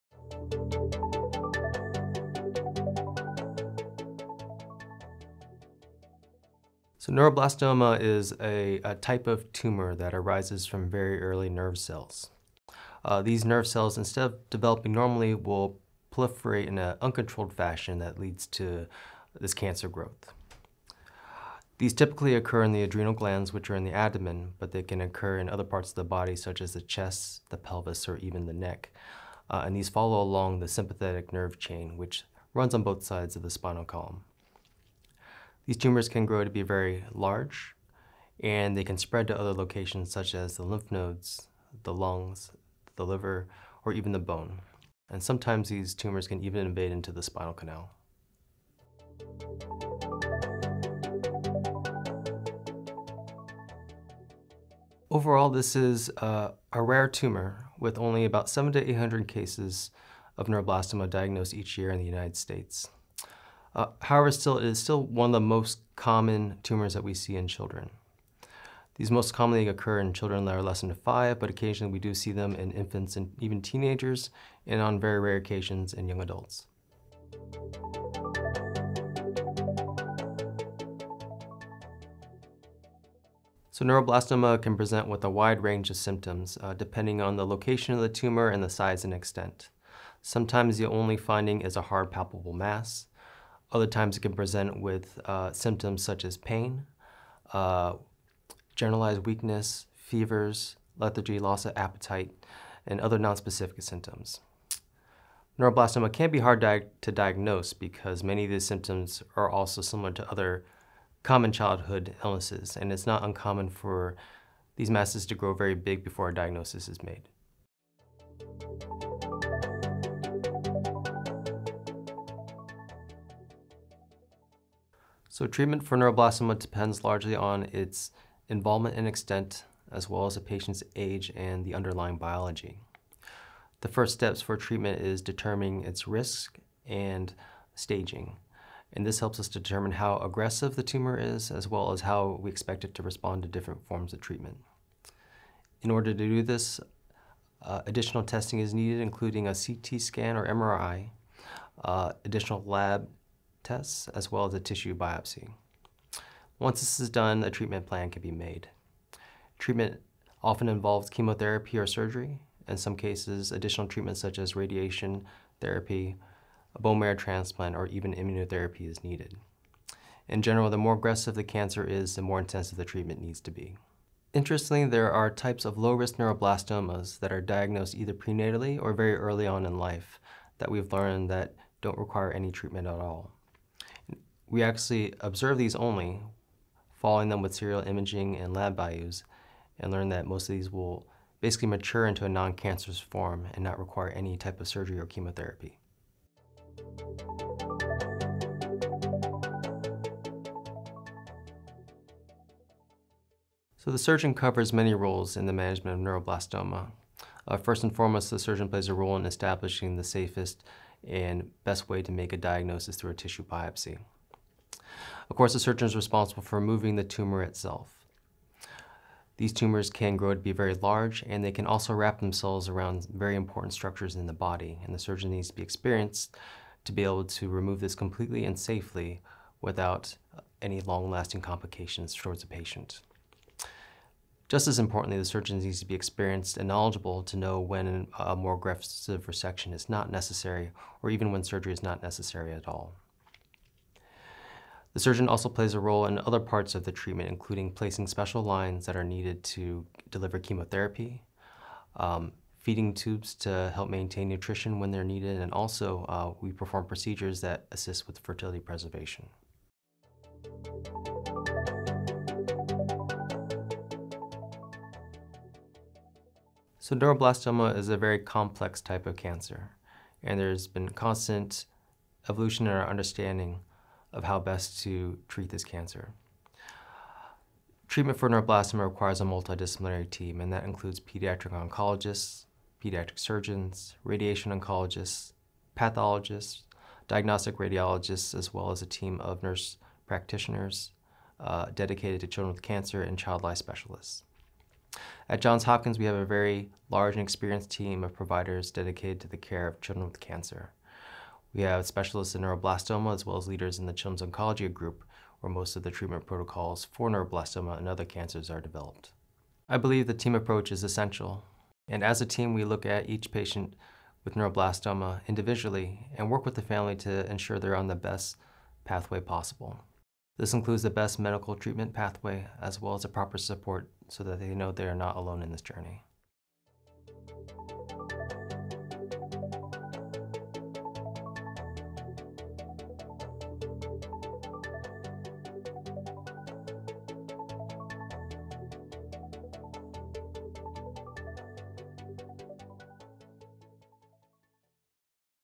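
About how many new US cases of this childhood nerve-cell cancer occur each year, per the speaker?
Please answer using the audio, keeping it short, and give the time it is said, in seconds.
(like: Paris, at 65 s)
700 to 800, at 58 s.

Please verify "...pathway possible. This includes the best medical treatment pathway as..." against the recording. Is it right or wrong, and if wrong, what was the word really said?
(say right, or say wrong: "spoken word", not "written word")
right.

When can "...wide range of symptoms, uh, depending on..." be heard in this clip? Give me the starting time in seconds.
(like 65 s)
85 s.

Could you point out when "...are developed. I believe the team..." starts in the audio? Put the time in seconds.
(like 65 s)
308 s.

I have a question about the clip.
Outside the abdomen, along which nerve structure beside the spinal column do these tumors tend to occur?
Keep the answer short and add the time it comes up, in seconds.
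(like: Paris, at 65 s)
sympathetic nerve chain, at 30 s.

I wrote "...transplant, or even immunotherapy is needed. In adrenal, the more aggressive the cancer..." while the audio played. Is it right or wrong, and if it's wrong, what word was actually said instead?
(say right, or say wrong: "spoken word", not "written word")
wrong: "general", not "adrenal".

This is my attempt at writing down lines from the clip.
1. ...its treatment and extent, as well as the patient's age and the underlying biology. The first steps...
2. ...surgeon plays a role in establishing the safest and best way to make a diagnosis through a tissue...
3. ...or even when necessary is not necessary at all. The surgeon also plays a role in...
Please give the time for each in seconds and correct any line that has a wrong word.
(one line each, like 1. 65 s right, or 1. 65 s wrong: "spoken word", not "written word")
1. 127 s wrong: "involvement", not "treatment"
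2. 208 s right
3. 241 s wrong: "surgery", not "necessary".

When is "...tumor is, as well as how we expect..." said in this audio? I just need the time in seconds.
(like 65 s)
140 s.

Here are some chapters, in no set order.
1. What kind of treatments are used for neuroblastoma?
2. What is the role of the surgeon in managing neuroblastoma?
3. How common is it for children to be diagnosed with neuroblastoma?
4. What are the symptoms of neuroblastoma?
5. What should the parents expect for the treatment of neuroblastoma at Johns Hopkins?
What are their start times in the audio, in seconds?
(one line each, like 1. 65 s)
1. 122 s
2. 199 s
3. 52 s
4. 81 s
5. 264 s.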